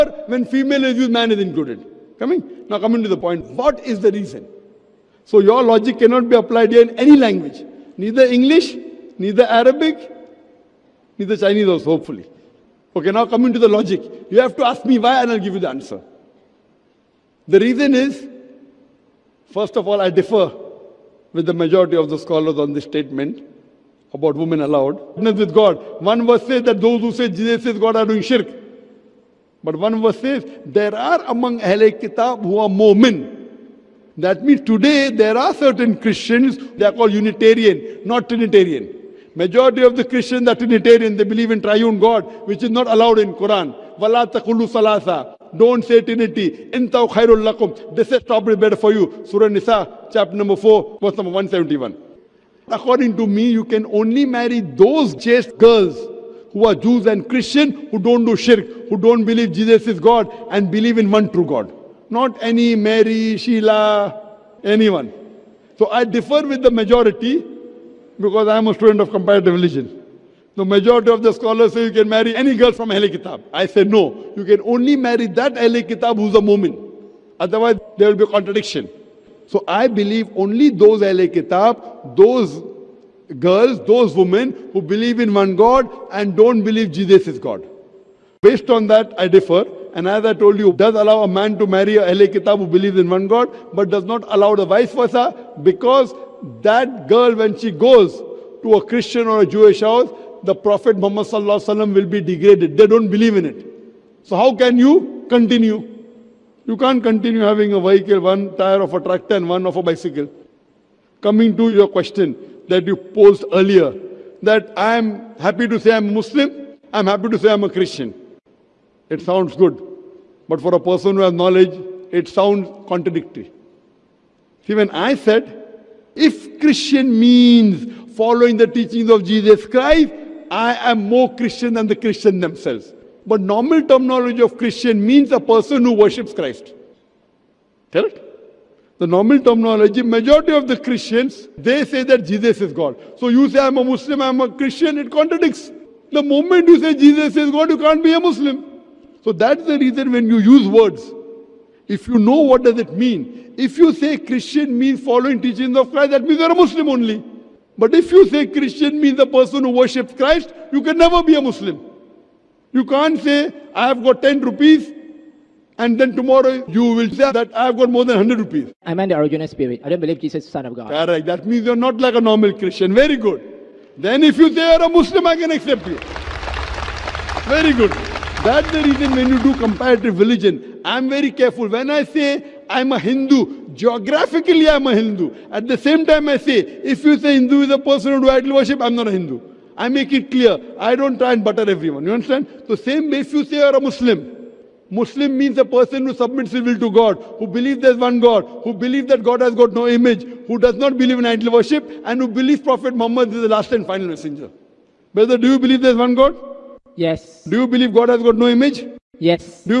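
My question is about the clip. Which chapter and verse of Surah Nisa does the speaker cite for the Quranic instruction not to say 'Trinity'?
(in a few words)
Chapter 4, verse 171.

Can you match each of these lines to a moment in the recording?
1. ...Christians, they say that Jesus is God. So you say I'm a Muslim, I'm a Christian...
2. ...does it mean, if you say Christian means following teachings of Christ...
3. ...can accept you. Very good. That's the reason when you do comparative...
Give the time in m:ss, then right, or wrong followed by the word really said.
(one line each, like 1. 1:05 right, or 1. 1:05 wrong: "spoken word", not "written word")
1. 2:20 right
2. 2:32 right
3. 2:55 right.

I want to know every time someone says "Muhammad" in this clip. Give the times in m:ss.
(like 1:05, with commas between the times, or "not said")
1:40, 3:23.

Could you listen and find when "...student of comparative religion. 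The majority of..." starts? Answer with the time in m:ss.
1:08.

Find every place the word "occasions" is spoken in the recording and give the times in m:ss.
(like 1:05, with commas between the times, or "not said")
not said.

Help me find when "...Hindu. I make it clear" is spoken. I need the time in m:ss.
3:09.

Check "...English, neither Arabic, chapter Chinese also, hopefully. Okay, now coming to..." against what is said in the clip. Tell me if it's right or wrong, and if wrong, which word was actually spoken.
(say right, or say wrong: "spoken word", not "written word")
wrong: "neither", not "chapter".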